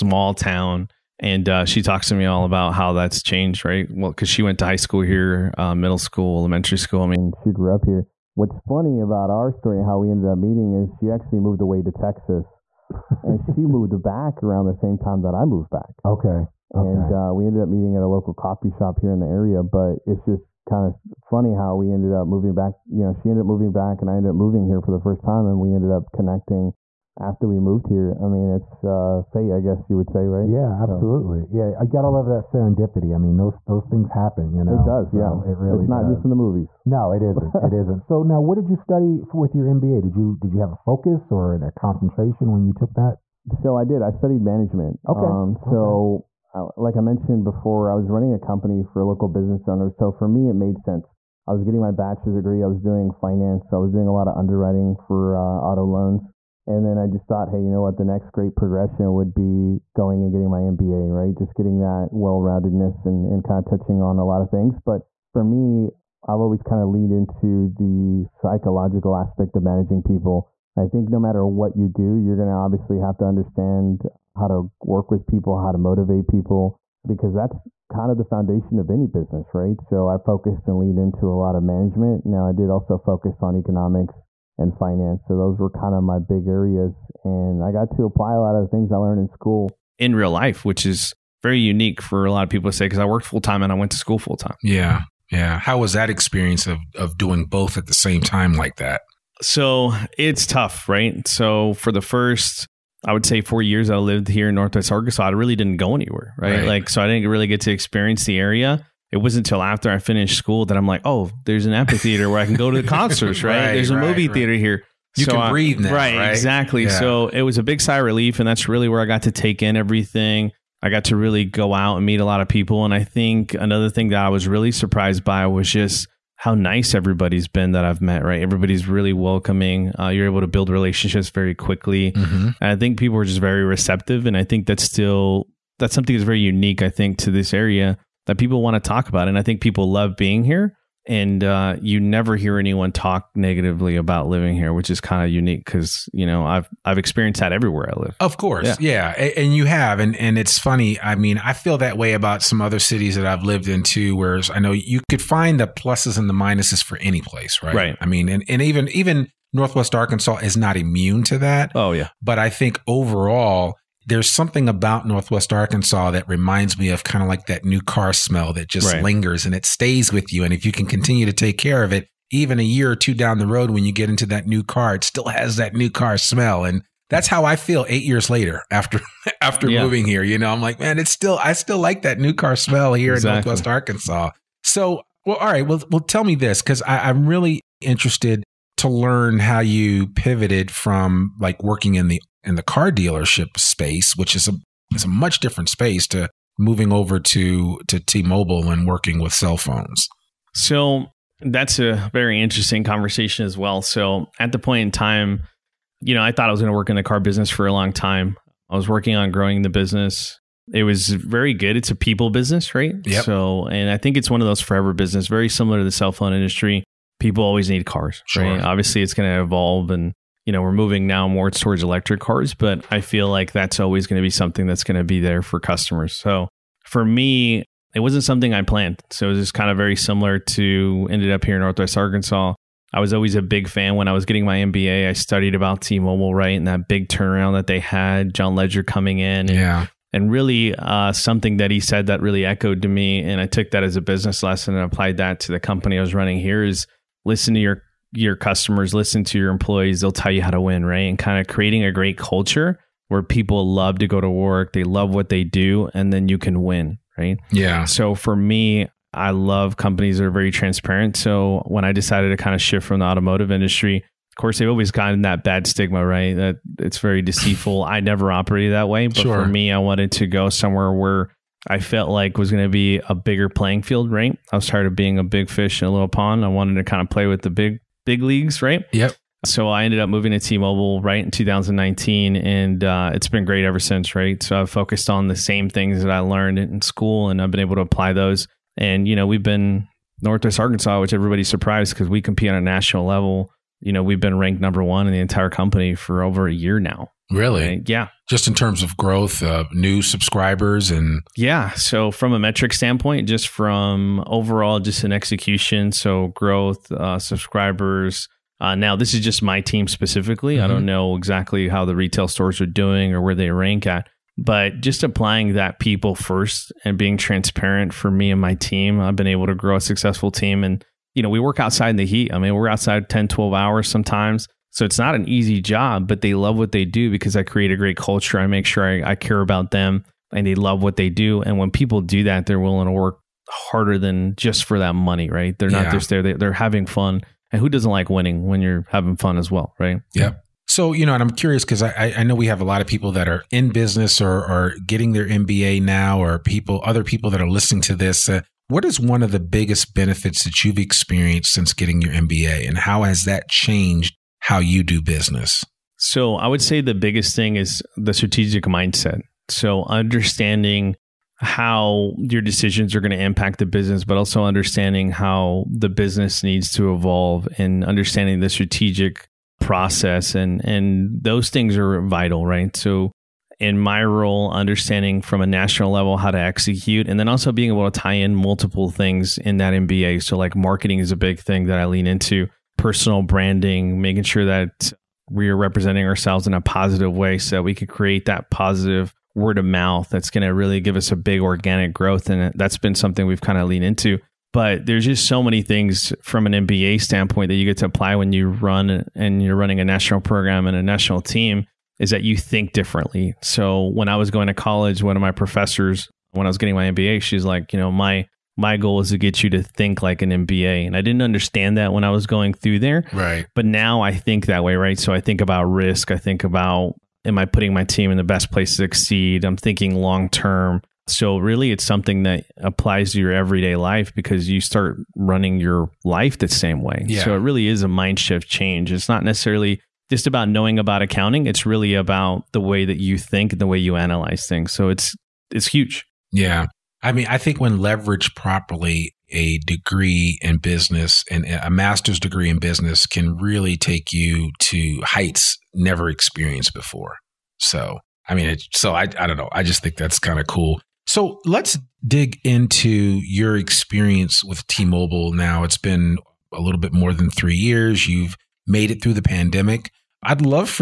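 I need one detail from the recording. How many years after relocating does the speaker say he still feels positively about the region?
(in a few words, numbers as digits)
8.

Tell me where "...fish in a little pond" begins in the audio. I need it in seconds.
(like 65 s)
275 s.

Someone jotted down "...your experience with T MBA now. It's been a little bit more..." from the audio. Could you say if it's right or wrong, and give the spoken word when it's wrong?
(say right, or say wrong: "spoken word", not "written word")
wrong: "Mobile", not "MBA".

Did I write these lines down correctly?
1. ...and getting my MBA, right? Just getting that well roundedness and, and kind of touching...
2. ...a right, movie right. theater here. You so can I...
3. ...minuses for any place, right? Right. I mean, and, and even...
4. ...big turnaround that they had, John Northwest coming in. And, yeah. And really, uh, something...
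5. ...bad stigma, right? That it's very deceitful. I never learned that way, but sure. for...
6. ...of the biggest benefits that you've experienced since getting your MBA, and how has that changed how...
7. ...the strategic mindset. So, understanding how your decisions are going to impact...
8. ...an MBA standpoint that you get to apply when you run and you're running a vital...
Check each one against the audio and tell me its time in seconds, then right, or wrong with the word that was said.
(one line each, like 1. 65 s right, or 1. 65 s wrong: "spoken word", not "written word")
1. 60 s right
2. 113 s right
3. 156 s right
4. 236 s wrong: "Legere", not "Northwest"
5. 265 s wrong: "operated", not "learned"
6. 349 s right
7. 357 s right
8. 396 s wrong: "national", not "vital".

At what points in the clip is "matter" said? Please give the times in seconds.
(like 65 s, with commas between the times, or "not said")
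71 s.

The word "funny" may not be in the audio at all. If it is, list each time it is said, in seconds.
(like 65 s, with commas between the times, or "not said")
8 s, 21 s, 150 s.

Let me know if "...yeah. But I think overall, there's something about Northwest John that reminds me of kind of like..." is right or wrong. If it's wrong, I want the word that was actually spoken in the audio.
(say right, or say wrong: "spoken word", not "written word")
wrong: "Arkansas", not "John".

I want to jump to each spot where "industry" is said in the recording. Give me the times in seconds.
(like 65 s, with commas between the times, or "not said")
216 s, 263 s.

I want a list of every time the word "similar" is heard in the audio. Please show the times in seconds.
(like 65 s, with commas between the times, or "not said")
215 s, 229 s.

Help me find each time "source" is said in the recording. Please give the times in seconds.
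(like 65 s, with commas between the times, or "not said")
not said.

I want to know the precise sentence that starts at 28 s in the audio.
I mean, it's uh, fate, I guess you would say, right?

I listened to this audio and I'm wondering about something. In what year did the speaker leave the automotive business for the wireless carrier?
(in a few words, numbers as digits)
2019.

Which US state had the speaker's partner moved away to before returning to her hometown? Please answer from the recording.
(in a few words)
Texas.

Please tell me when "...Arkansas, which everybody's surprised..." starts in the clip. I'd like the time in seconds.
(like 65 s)
290 s.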